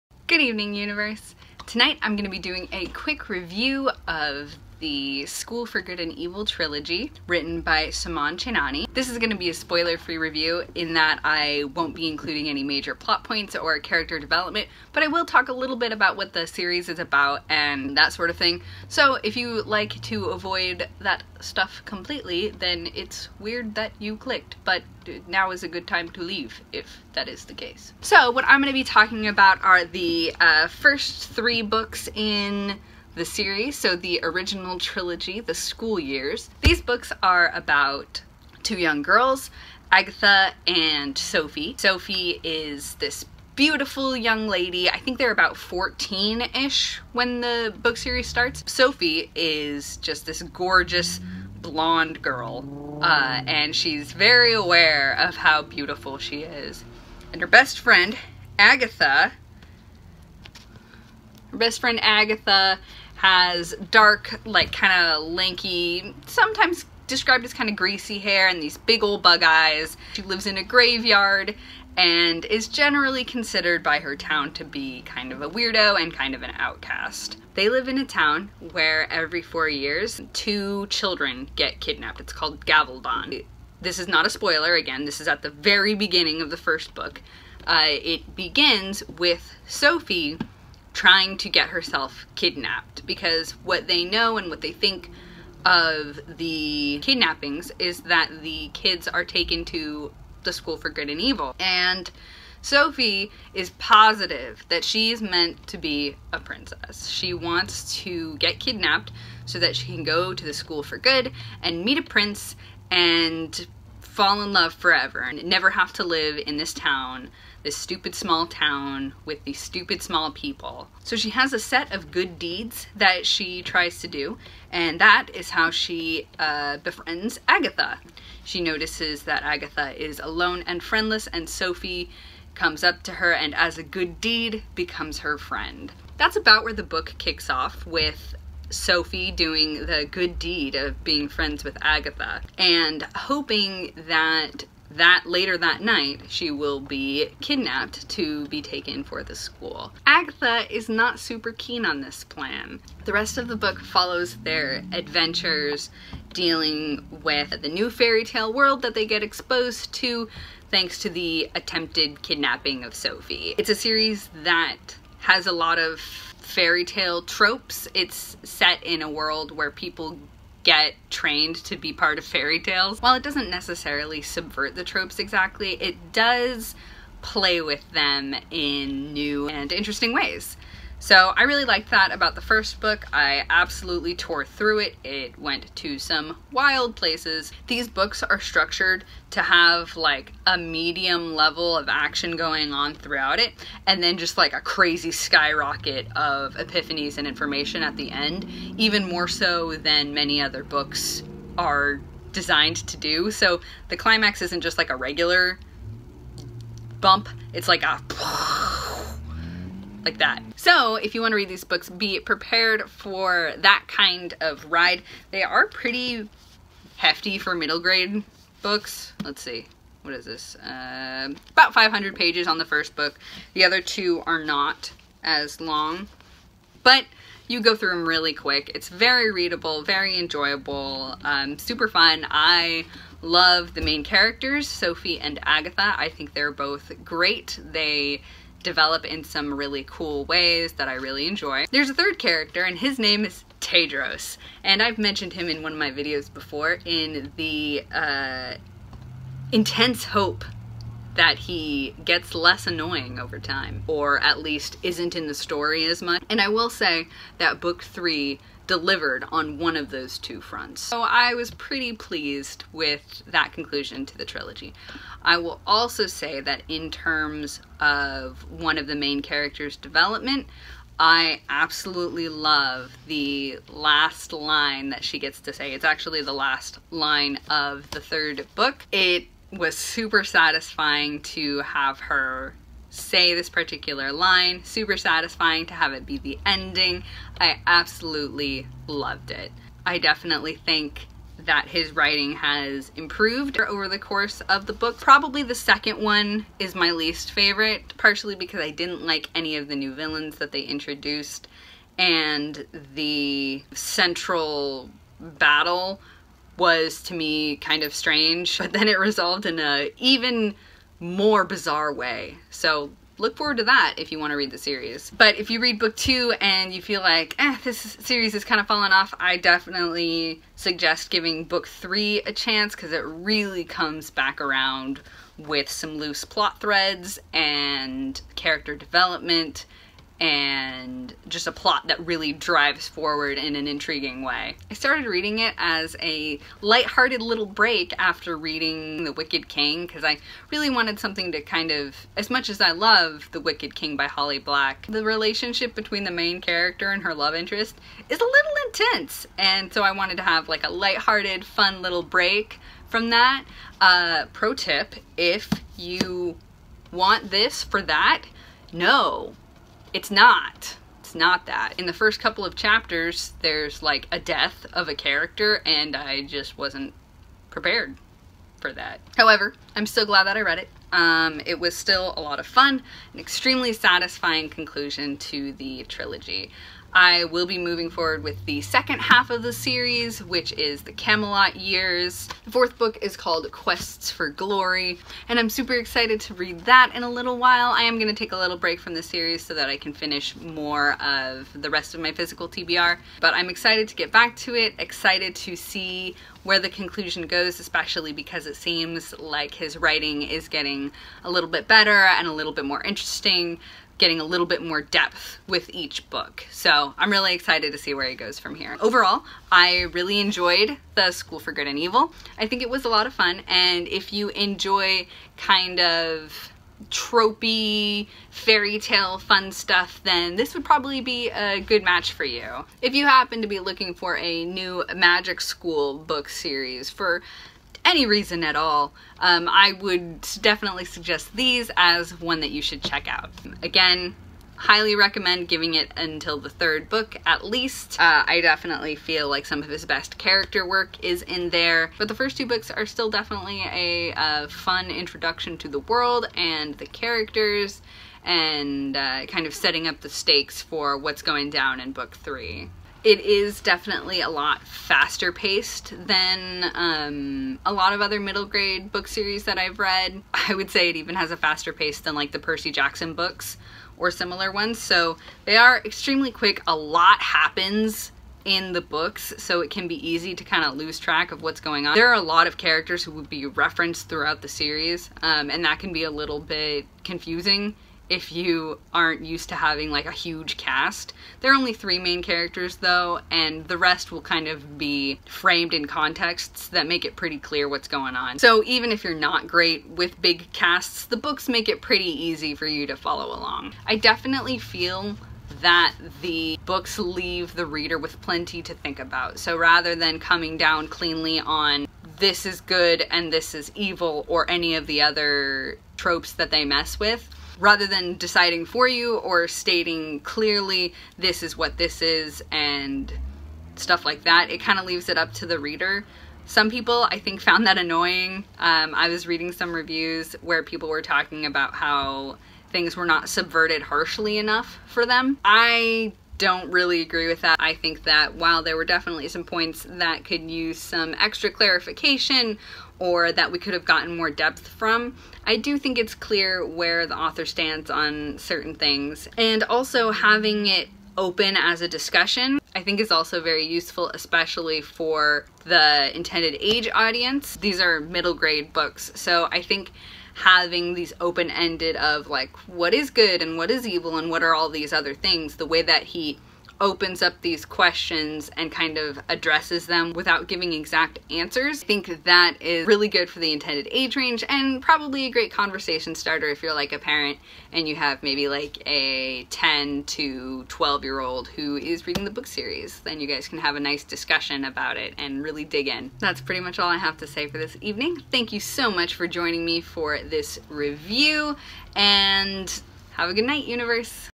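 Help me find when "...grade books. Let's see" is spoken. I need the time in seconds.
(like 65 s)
217 s.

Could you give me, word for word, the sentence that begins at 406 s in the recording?
So I'm really excited to see where it goes from here.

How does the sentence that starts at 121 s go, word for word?
So she has a set of good deeds that she tries to do, and that is how she uh, befriends Agatha.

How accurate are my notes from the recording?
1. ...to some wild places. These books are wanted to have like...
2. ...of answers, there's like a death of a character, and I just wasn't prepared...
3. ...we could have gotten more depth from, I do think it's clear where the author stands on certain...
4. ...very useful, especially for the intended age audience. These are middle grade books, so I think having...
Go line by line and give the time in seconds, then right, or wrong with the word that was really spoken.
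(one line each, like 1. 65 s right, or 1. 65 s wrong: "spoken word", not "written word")
1. 185 s wrong: "structured", not "wanted"
2. 362 s wrong: "chapters", not "answers"
3. 533 s right
4. 543 s right.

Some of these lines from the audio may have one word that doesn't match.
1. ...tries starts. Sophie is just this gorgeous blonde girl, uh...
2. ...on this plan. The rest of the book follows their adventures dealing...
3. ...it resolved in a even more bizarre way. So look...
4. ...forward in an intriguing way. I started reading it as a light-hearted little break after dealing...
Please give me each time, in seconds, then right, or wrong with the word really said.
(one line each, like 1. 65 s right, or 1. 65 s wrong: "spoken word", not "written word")
1. 47 s wrong: "series", not "tries"
2. 151 s right
3. 308 s right
4. 332 s wrong: "reading", not "dealing".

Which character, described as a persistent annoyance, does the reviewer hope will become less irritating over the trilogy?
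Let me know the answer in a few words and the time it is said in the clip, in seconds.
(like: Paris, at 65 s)
Tedros, at 243 s.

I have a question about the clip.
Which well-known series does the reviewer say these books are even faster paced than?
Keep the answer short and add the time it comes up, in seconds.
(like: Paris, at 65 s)
Percy Jackson, at 462 s.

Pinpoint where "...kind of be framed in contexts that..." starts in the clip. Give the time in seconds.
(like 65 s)
484 s.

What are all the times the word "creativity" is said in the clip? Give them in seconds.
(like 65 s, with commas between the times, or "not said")
not said.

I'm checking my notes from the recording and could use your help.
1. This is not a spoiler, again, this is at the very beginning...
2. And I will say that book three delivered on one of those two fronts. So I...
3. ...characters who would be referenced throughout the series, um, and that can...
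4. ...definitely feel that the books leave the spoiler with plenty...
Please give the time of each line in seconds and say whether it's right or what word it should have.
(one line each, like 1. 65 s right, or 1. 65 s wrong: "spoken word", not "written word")
1. 83 s right
2. 256 s right
3. 472 s right
4. 493 s wrong: "reader", not "spoiler".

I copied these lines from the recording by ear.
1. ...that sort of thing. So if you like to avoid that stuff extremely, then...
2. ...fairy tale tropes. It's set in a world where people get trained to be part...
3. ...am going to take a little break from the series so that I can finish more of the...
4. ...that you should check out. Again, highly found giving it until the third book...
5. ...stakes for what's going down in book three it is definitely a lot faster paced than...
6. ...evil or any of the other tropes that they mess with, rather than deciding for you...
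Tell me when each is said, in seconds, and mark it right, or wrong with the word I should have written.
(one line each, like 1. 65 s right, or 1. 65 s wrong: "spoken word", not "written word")
1. 17 s wrong: "completely", not "extremely"
2. 165 s right
3. 387 s right
4. 432 s wrong: "recommend", not "found"
5. 450 s right
6. 503 s right.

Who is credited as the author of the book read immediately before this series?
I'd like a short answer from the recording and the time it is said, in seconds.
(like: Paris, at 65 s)
Holly Black, at 344 s.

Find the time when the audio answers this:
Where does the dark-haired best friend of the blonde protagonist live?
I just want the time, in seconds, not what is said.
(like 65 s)
70 s.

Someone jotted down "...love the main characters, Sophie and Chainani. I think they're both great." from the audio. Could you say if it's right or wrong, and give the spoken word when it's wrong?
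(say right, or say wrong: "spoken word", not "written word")
wrong: "Agatha", not "Chainani".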